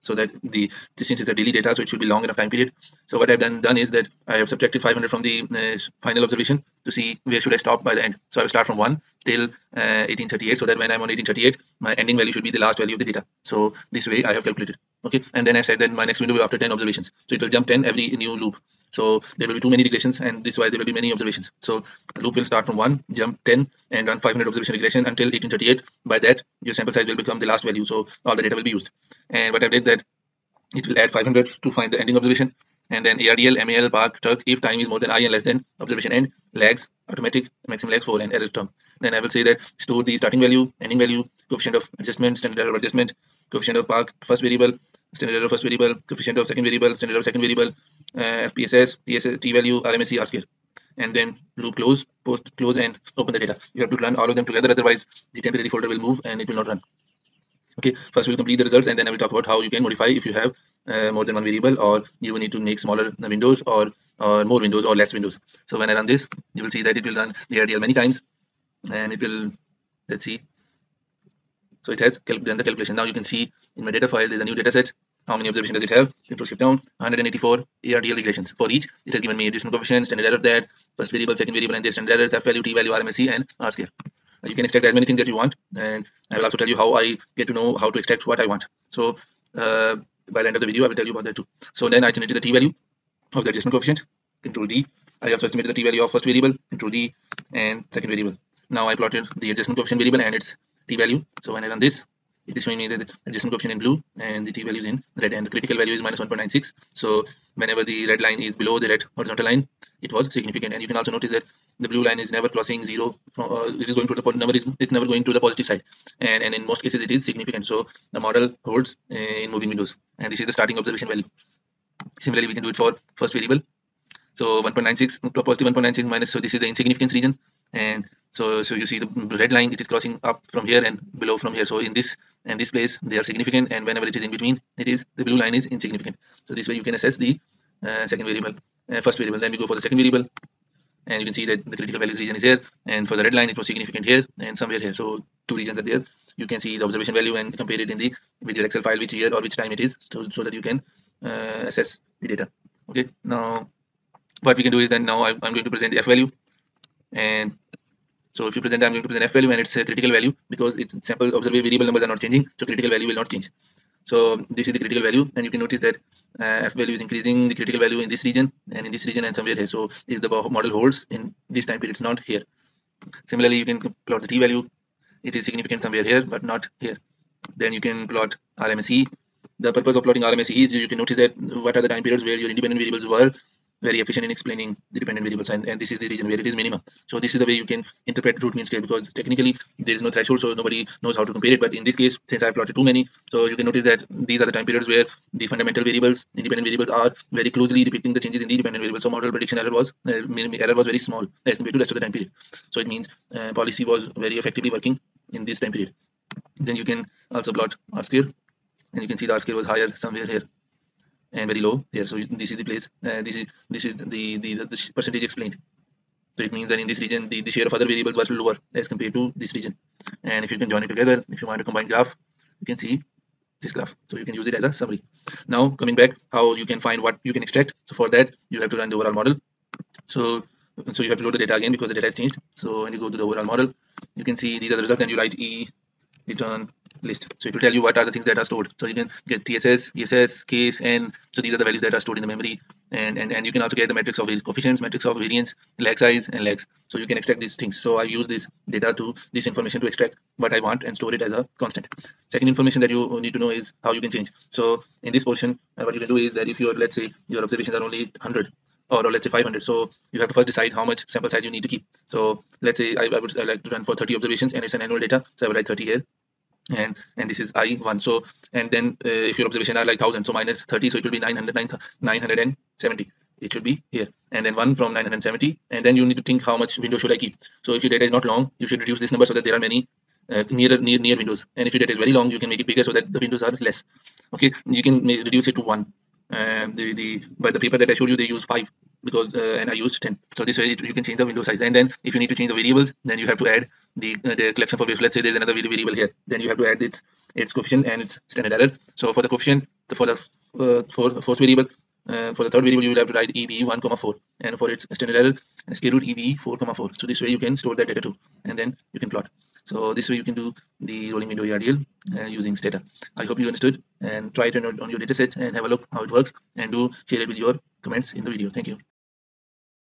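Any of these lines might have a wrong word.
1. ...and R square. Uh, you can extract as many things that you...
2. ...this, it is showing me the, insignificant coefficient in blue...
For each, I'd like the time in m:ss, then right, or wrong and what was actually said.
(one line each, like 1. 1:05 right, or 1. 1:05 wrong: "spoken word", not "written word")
1. 1:23 right
2. 1:41 wrong: "adjustment", not "insignificant".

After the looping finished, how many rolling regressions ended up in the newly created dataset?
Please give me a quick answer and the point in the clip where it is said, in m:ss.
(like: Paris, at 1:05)
184, at 1:16.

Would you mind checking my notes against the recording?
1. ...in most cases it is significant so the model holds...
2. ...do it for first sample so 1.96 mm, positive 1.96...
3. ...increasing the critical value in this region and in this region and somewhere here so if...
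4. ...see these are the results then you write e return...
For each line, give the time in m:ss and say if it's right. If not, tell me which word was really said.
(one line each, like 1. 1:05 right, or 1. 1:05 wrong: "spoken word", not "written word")
1. 1:56 right
2. 2:02 wrong: "variable", not "sample"
3. 2:47 right
4. 3:54 right.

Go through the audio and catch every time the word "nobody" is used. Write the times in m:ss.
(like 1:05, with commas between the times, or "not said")
3:10.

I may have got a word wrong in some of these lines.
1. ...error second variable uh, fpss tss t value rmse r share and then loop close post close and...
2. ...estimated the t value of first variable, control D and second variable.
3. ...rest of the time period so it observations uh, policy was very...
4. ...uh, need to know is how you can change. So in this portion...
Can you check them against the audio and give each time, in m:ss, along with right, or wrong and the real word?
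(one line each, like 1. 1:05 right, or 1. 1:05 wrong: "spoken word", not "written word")
1. 0:47 wrong: "square", not "share"
2. 1:35 right
3. 3:21 wrong: "means", not "observations"
4. 4:13 right.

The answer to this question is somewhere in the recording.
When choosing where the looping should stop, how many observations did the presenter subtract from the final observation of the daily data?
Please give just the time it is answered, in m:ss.
0:04.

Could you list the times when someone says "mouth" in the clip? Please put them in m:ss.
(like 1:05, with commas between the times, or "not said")
not said.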